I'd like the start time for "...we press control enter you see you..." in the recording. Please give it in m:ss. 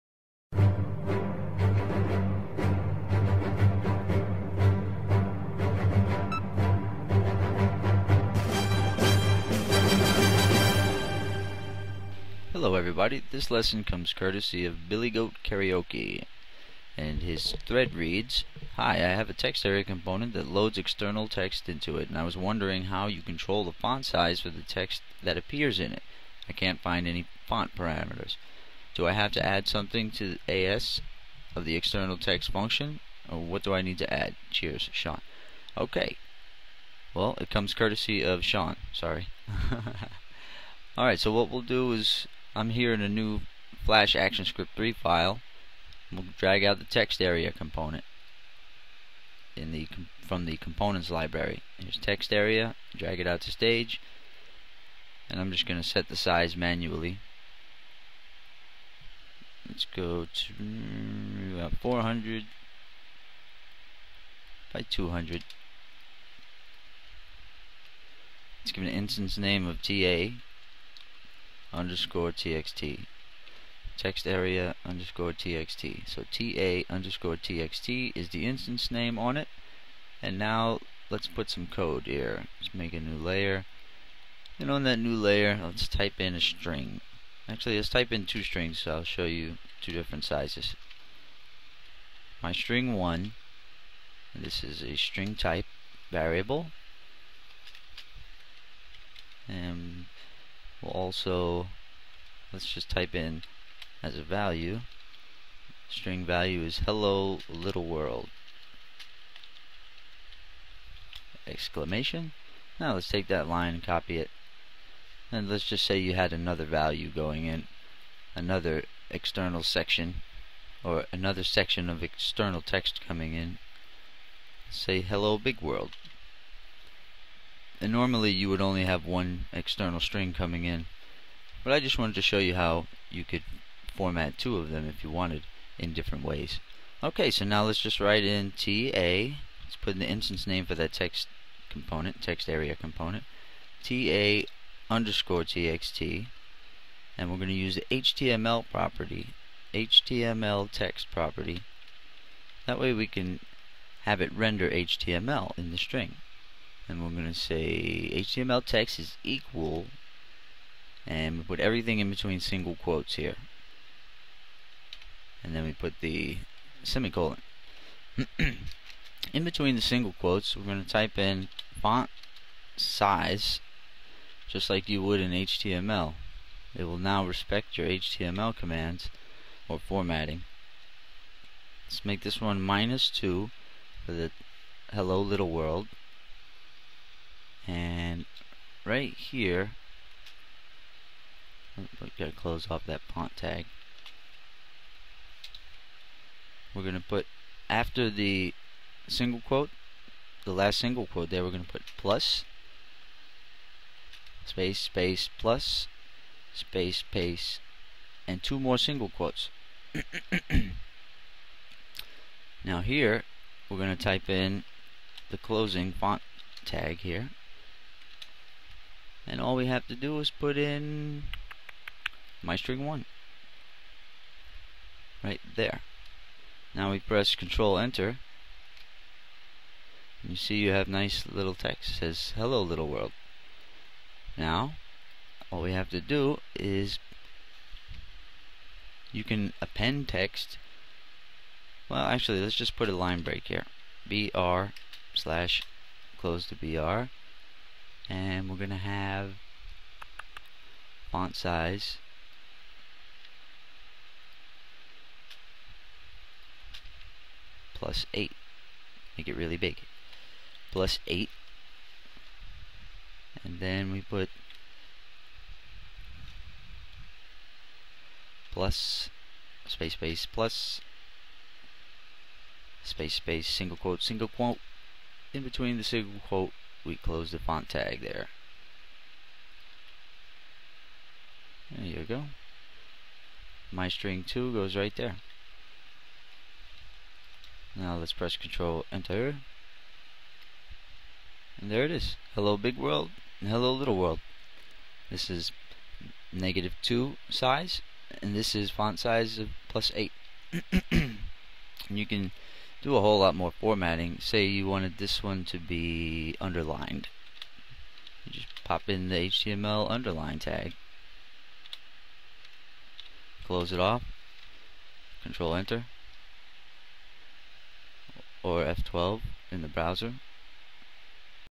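3:46.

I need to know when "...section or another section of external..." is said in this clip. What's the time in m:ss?
1:59.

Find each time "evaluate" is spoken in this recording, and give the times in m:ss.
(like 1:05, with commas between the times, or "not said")
not said.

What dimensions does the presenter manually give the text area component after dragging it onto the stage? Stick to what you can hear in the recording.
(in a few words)
400 by 200.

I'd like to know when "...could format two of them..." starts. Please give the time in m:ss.
2:13.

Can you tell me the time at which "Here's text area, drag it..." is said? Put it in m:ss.
0:51.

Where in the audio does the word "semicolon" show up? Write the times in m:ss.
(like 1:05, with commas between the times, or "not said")
2:46.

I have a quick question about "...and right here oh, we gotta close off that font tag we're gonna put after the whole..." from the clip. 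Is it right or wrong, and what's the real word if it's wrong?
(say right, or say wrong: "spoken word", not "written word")
wrong: "single", not "whole".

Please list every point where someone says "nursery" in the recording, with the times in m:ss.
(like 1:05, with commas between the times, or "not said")
not said.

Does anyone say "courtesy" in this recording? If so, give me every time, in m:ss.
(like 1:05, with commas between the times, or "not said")
0:14, 0:37.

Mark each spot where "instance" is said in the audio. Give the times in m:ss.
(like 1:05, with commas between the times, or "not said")
1:08, 1:18, 2:20.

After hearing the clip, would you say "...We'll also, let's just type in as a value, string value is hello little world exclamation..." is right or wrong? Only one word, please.
right.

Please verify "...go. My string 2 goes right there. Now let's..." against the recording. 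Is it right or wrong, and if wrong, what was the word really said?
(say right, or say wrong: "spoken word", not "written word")
right.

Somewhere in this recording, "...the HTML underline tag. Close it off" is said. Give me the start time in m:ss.
5:09.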